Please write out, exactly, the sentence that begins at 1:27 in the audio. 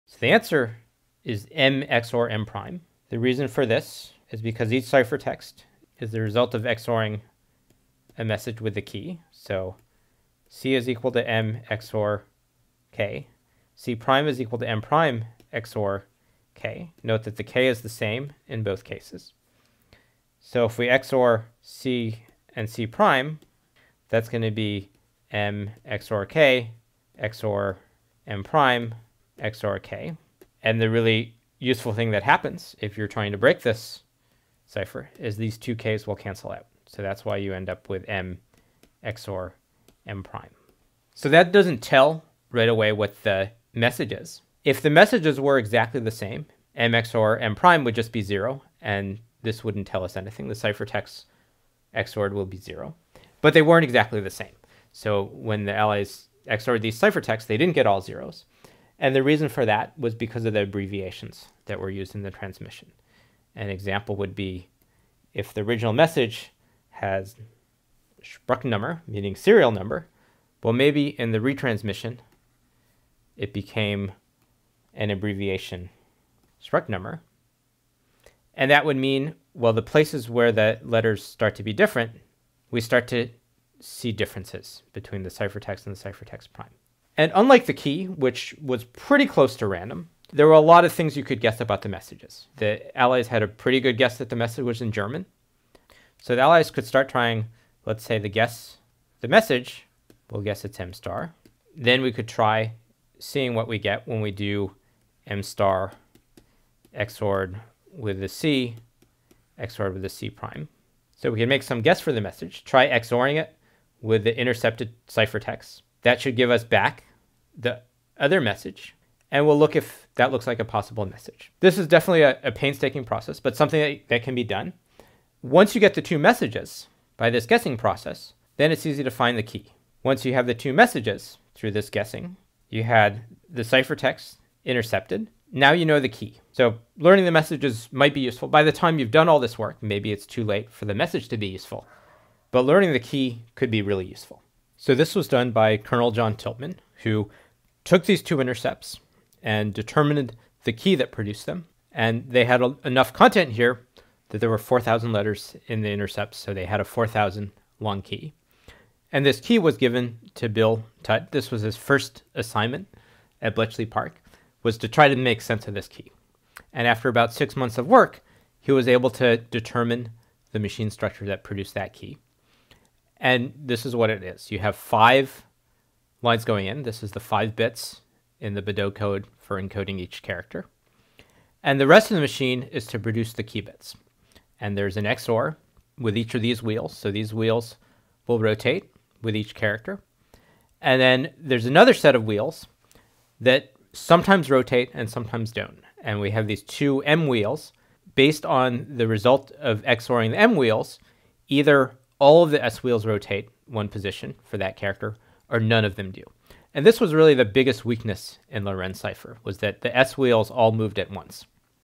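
And unlike the key, which was pretty close to random, there were a lot of things you could guess about the messages.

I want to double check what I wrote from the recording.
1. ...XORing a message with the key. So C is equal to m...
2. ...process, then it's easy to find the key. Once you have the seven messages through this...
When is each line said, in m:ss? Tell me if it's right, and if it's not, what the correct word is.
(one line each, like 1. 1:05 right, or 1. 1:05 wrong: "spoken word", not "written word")
1. 0:06 right
2. 2:07 wrong: "two", not "seven".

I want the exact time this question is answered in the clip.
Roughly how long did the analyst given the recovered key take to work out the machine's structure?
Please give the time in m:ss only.
2:47.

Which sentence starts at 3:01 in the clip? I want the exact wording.
And the rest of the machine is to produce the key bits.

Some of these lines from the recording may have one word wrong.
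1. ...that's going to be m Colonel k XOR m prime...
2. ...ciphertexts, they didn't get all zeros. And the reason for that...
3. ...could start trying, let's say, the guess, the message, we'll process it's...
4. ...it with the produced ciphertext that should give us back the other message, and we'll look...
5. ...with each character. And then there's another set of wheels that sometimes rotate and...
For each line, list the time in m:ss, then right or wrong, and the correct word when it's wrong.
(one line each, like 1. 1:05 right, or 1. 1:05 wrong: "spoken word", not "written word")
1. 0:24 wrong: "XOR", not "Colonel"
2. 0:56 right
3. 1:36 wrong: "guess", not "process"
4. 1:53 wrong: "intercepted", not "produced"
5. 3:09 right.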